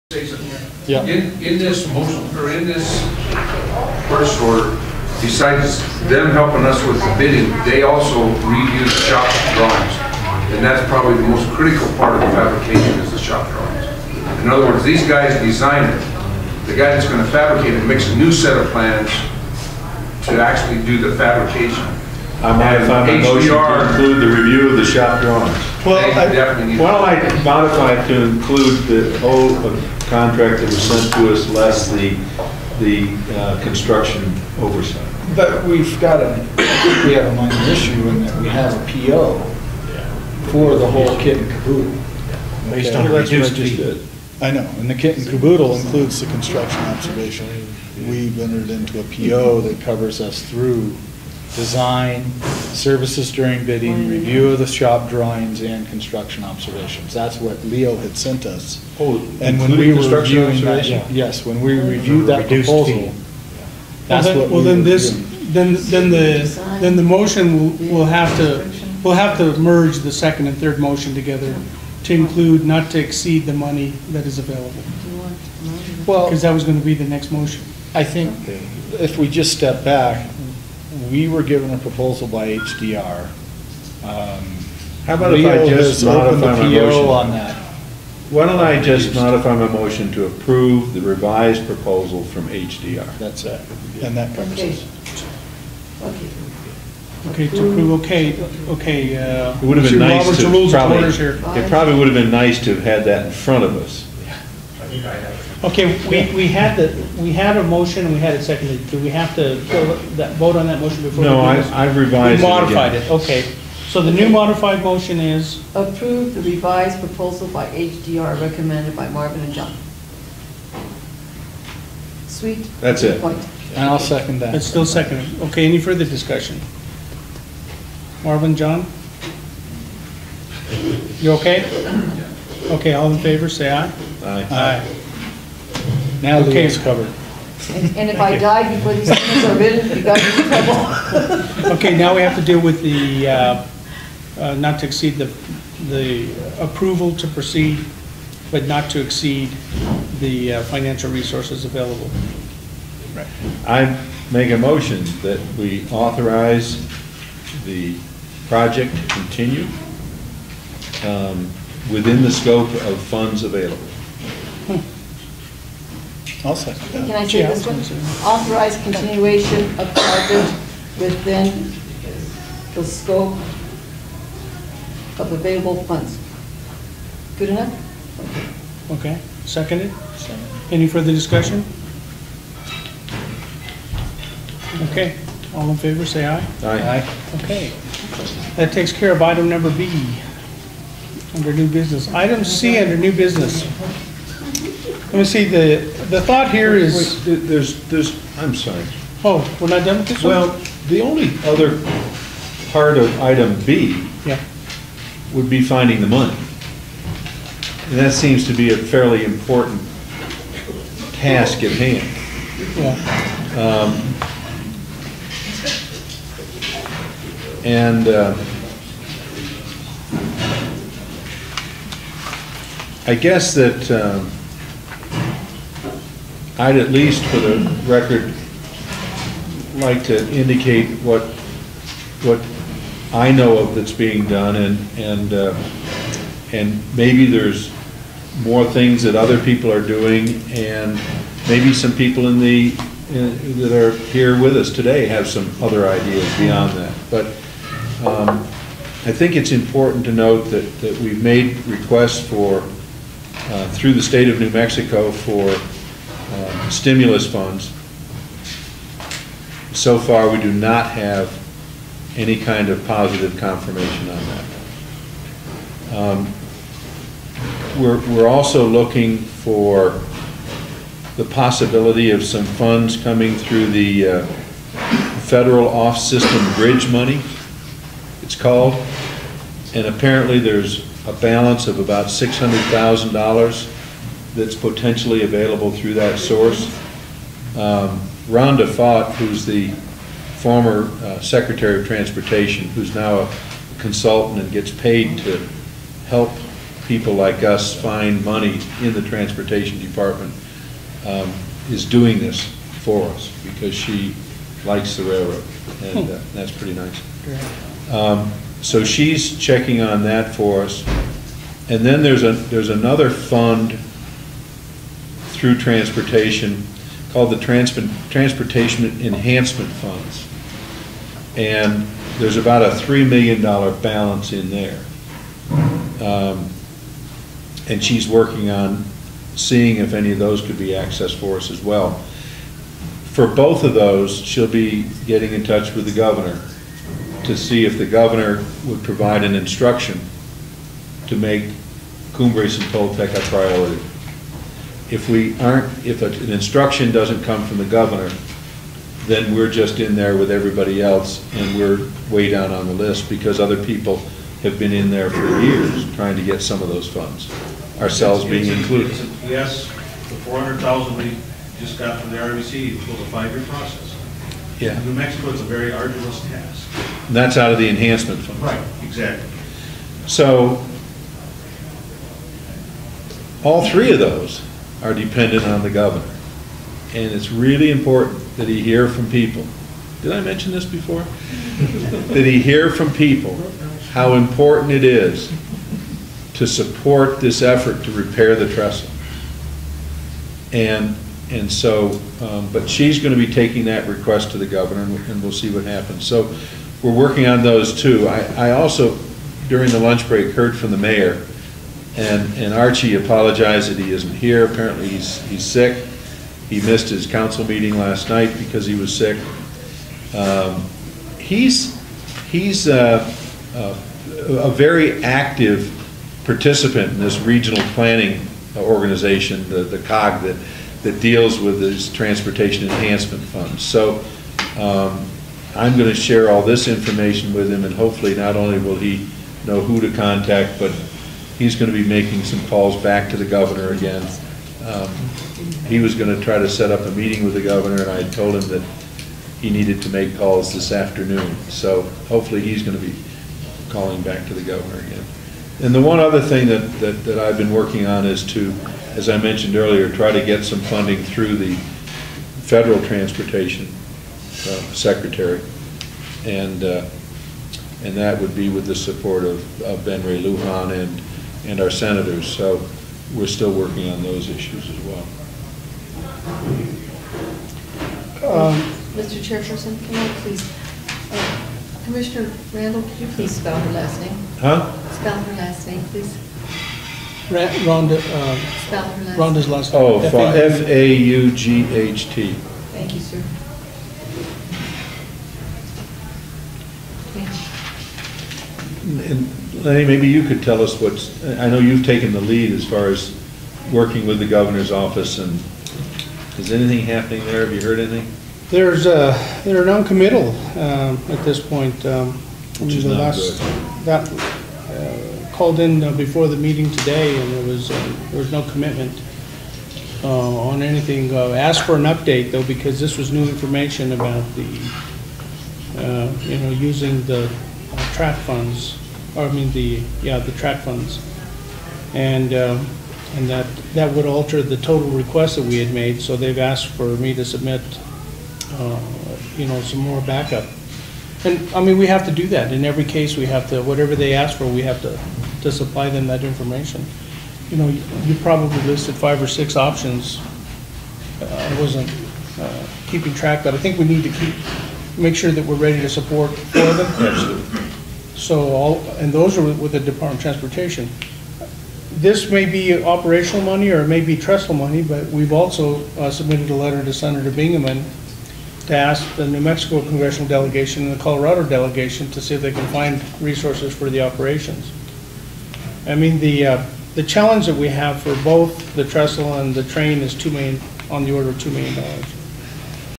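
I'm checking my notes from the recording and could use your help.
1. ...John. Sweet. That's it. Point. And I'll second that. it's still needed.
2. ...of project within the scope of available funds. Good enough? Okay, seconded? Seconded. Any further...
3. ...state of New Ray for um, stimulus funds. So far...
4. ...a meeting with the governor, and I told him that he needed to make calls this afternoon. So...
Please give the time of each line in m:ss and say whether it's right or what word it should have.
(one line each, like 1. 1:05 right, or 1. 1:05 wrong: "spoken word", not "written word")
1. 1:59 wrong: "seconded", not "needed"
2. 2:49 right
3. 4:14 wrong: "Mexico", not "Ray"
4. 7:16 right.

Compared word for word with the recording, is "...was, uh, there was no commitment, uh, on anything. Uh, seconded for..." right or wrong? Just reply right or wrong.
wrong.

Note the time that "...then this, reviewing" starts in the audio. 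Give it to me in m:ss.
1:04.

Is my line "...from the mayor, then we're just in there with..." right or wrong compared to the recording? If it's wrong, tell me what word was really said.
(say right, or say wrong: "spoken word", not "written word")
wrong: "governor", not "mayor".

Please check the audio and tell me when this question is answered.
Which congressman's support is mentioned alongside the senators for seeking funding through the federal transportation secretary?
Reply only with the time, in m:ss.
7:39.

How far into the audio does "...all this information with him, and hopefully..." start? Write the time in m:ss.
7:06.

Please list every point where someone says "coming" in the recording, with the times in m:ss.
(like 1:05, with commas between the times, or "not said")
4:32.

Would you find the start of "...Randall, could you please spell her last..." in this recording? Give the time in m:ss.
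7:52.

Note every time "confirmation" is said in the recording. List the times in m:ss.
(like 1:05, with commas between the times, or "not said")
4:23.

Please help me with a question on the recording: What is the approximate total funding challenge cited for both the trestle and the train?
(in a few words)
$2 million.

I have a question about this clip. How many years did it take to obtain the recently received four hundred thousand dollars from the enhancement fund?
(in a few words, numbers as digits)
5 years.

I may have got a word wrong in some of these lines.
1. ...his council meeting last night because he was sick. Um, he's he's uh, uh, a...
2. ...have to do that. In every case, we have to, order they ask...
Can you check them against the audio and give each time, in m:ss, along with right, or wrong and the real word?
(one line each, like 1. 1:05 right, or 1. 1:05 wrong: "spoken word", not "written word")
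1. 6:46 right
2. 8:51 wrong: "whatever", not "order".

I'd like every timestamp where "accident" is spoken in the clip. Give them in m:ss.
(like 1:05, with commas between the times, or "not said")
not said.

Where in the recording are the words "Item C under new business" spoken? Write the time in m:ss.
3:12.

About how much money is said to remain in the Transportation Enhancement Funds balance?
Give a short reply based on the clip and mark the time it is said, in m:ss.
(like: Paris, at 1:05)
$3 million, at 5:22.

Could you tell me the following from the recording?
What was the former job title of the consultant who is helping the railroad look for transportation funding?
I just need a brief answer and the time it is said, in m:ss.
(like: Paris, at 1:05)
Secretary of Transportation, at 4:51.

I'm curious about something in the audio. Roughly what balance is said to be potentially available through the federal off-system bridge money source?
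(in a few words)
$600,000.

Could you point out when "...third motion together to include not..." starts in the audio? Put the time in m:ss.
1:10.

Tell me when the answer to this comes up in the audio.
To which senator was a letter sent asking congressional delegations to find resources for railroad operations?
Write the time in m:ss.
9:16.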